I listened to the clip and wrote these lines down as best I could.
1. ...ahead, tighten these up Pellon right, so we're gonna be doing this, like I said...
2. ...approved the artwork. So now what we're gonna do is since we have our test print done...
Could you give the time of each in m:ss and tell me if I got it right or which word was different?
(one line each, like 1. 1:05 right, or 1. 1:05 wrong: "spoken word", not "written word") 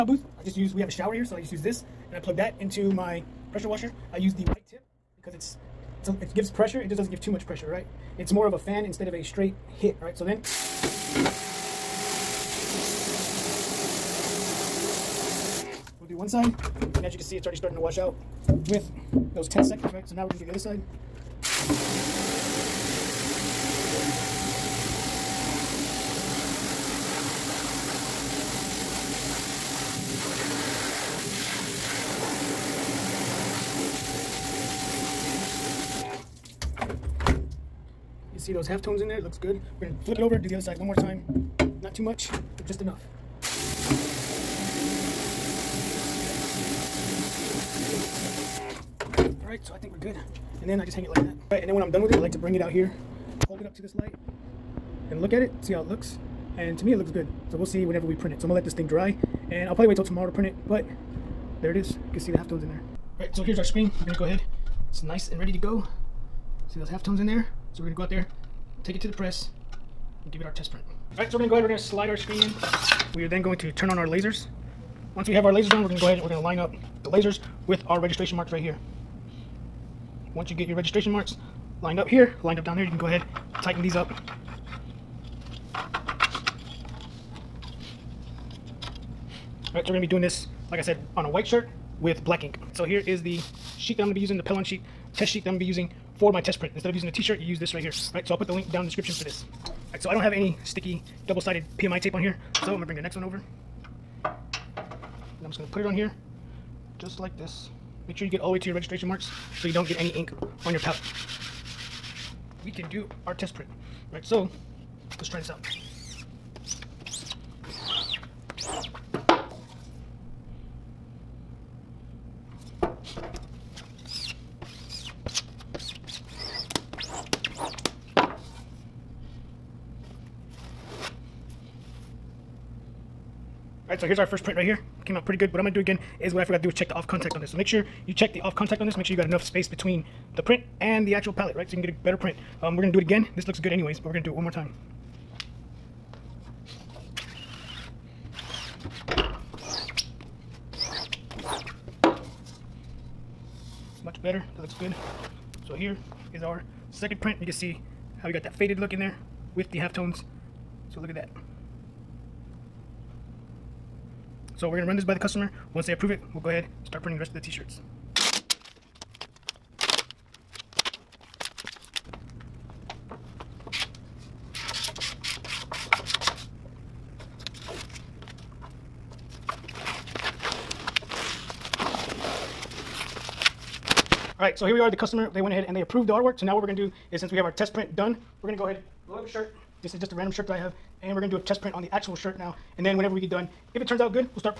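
1. 1:23 wrong: "All", not "Pellon"
2. 3:05 right.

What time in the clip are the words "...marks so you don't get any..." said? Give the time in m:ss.
1:49.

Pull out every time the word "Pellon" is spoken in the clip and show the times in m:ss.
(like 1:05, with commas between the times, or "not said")
1:34.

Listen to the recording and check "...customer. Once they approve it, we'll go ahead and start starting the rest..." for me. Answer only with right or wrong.
wrong.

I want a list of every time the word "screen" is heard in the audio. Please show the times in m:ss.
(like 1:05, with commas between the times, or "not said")
1:03, 1:12.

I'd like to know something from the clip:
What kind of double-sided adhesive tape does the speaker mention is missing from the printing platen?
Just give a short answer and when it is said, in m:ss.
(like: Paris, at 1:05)
PMI tape, at 1:41.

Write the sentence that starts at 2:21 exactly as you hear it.
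So you can get a better print.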